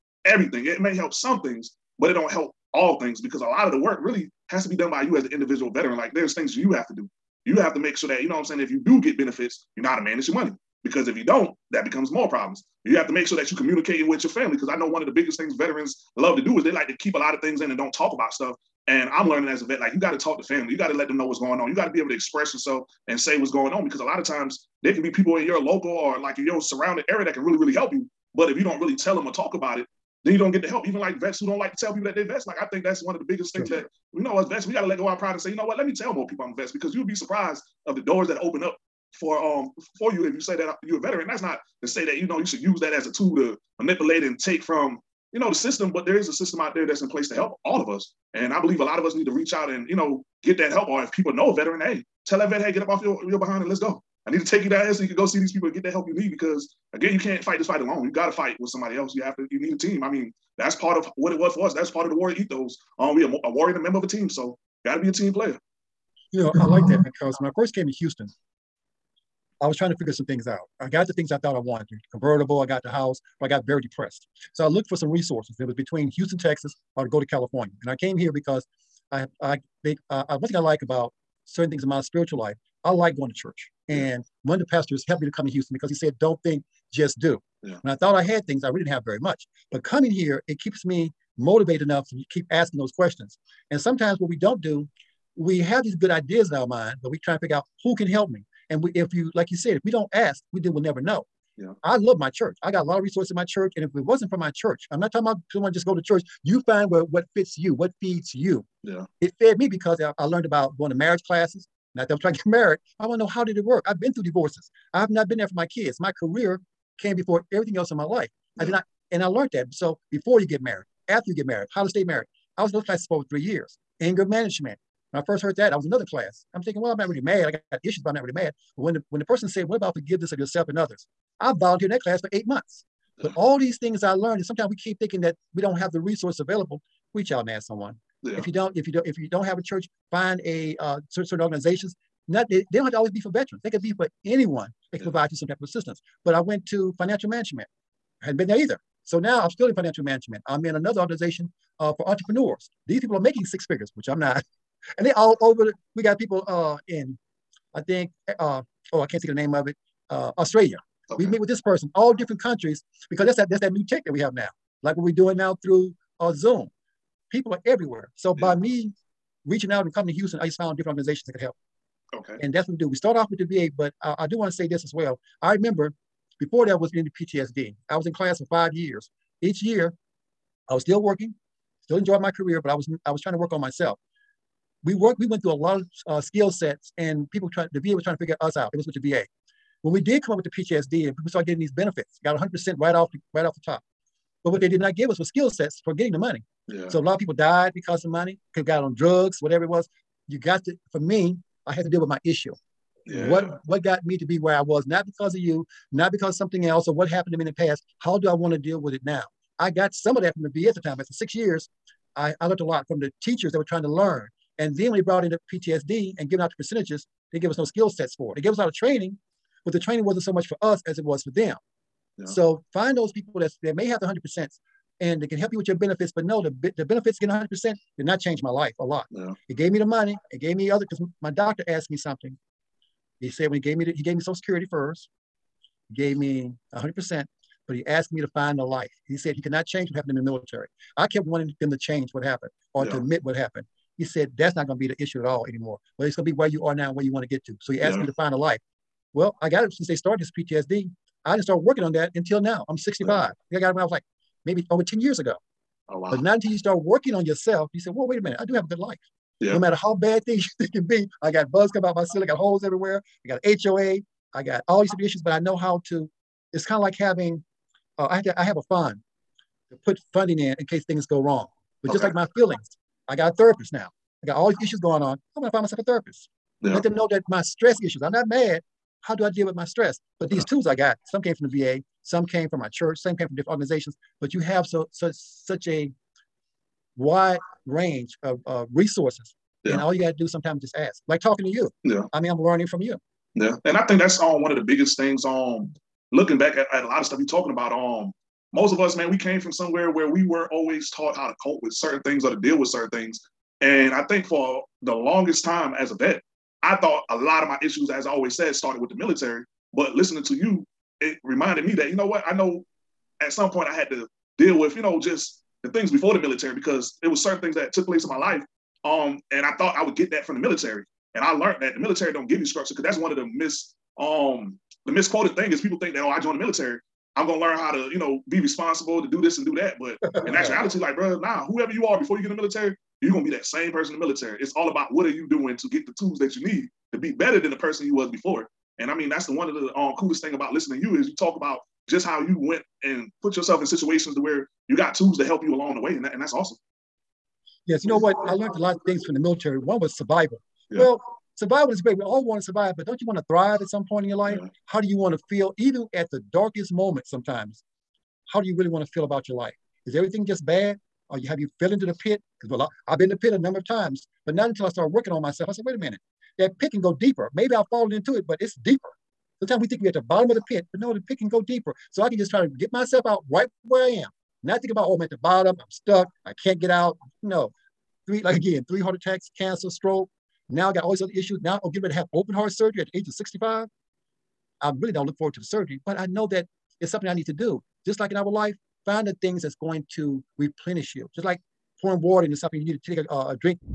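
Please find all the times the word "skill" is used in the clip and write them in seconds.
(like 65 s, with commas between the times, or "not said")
186 s, 195 s, 217 s.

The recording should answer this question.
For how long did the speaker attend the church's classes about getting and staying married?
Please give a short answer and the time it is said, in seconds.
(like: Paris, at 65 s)
3 years, at 123 s.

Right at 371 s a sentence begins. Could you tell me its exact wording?
So I can just try to get myself out right where I am.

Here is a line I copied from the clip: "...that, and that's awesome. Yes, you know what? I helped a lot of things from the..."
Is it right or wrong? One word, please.
wrong.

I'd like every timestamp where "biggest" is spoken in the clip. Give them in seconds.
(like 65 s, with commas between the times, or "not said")
15 s, 33 s, 294 s.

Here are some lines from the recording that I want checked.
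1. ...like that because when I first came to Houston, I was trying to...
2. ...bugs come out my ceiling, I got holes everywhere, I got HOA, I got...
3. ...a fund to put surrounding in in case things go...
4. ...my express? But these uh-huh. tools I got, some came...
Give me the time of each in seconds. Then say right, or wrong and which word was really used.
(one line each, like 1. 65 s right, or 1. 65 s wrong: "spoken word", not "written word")
1. 66 s right
2. 261 s right
3. 268 s wrong: "funding", not "surrounding"
4. 279 s wrong: "stress", not "express".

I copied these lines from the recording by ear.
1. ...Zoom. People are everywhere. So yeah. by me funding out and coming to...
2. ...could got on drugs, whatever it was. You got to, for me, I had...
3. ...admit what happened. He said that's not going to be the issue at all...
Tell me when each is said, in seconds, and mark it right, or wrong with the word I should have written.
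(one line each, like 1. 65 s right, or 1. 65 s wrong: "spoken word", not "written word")
1. 166 s wrong: "reaching", not "funding"
2. 198 s right
3. 242 s right.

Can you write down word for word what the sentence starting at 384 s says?
I really don't look forward to the surgery, but I know that it's something I need to do.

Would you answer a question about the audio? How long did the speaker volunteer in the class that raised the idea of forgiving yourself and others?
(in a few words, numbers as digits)
8 months.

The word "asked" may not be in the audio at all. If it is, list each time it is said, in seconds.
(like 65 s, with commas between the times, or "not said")
231 s, 237 s, 247 s.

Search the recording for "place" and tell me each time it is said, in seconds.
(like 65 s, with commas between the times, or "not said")
47 s, 317 s.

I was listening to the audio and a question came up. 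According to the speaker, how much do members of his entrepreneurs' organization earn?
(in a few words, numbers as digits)
six figures.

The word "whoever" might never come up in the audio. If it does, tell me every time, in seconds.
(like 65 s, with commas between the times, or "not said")
331 s.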